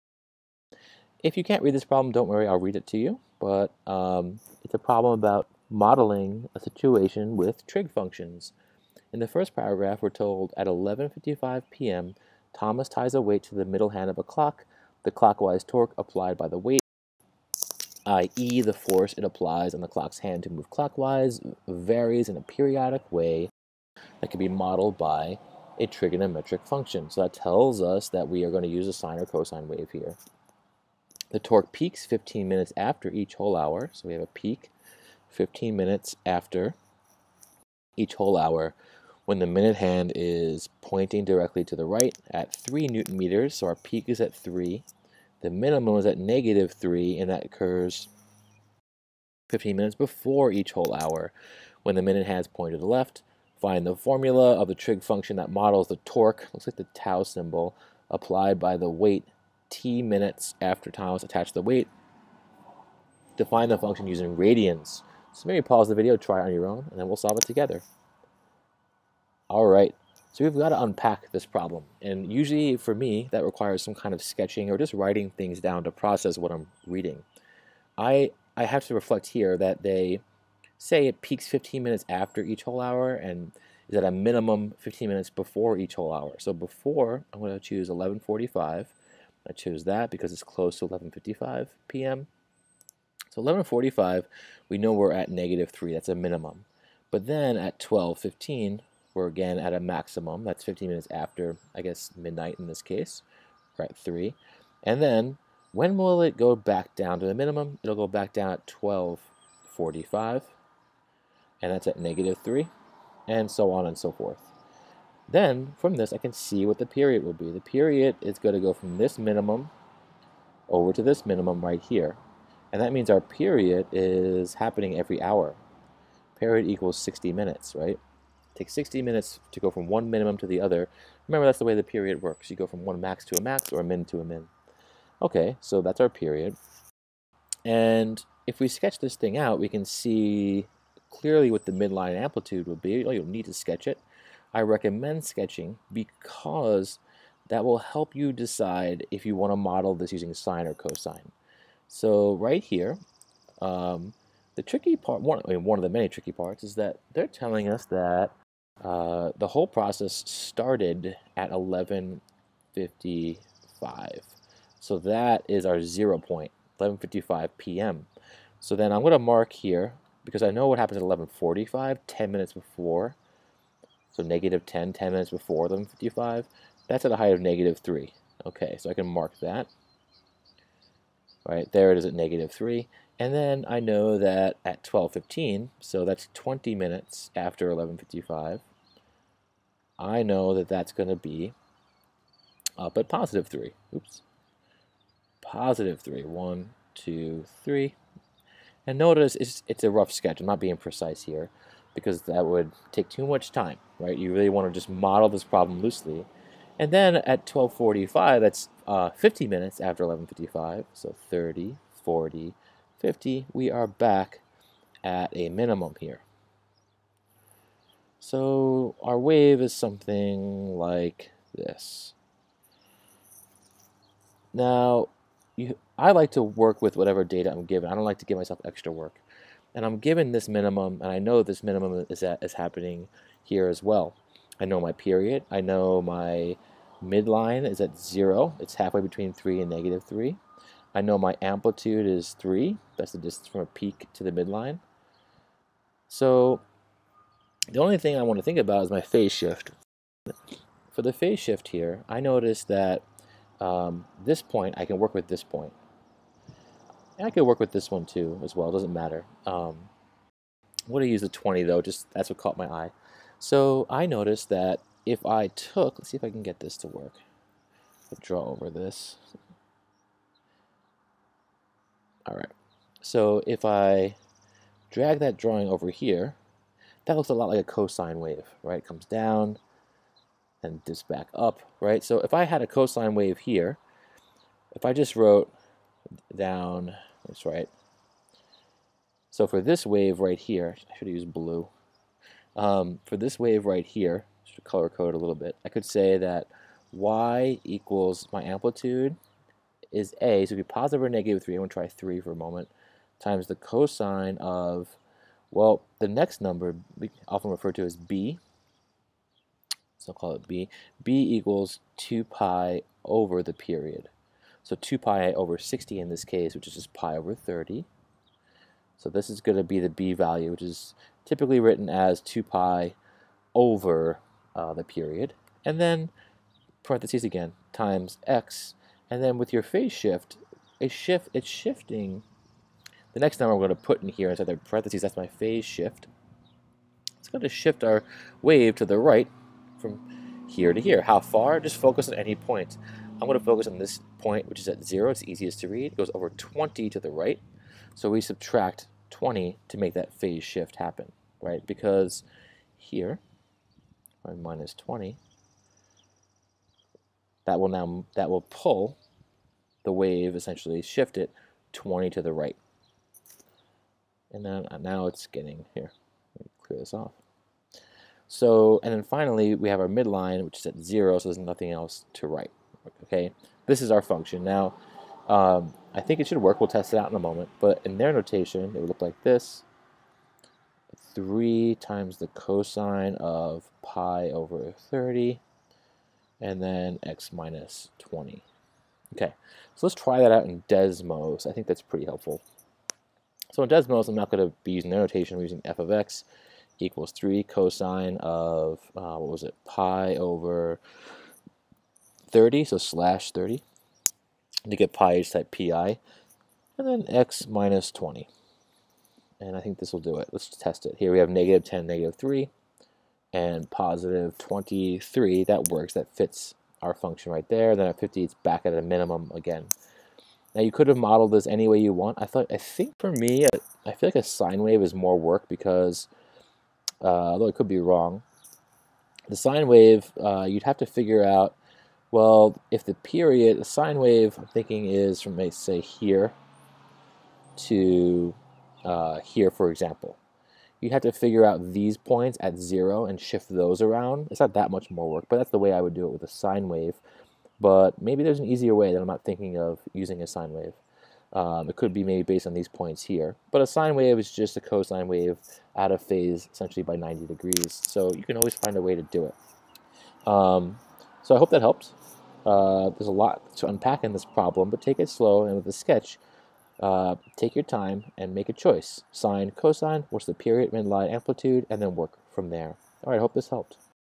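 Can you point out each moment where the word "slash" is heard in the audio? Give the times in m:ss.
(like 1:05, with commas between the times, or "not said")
6:42.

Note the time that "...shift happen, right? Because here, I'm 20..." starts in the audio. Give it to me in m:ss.
5:50.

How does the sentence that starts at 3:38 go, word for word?
So our wave is something like this.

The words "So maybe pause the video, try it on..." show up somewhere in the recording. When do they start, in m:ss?
1:05.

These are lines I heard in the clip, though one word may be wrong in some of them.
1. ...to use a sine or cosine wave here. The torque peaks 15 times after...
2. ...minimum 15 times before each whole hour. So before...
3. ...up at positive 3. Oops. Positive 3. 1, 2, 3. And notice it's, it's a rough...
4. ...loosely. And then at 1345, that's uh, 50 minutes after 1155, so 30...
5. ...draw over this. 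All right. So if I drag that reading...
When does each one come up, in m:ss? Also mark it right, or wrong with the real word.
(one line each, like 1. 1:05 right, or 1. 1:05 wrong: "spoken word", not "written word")
1. 0:28 wrong: "minutes", not "times"
2. 1:24 wrong: "minutes", not "times"
3. 3:12 right
4. 3:25 wrong: "1245", not "1345"
5. 4:28 wrong: "drawing", not "reading".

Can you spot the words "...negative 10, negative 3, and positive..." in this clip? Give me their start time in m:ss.
6:51.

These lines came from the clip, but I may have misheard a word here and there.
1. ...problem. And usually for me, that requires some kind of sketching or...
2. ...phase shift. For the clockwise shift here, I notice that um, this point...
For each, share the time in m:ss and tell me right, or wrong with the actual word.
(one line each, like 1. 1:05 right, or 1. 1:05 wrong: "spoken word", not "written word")
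1. 1:11 right
2. 4:09 wrong: "phase", not "clockwise".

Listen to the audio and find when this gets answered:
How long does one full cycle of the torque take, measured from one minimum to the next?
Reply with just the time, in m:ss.
2:06.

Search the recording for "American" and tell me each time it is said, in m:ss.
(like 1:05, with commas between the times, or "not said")
not said.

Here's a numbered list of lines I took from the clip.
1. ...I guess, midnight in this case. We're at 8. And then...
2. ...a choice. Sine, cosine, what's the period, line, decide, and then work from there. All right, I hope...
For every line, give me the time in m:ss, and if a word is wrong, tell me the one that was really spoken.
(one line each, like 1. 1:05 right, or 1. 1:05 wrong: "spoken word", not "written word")
1. 1:41 wrong: "3", not "8"
2. 7:48 wrong: "amplitude", not "decide".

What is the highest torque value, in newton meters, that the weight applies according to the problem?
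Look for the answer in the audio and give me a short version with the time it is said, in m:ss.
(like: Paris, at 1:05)
3 newton meters, at 0:42.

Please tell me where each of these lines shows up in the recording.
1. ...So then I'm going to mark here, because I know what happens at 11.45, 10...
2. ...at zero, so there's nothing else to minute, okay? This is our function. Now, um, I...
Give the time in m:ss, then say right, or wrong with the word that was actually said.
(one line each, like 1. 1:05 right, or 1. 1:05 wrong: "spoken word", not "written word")
1. 2:48 right
2. 6:10 wrong: "write", not "minute".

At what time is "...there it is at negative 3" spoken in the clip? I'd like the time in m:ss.
3:01.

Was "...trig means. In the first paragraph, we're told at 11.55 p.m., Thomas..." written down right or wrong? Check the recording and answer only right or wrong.
wrong.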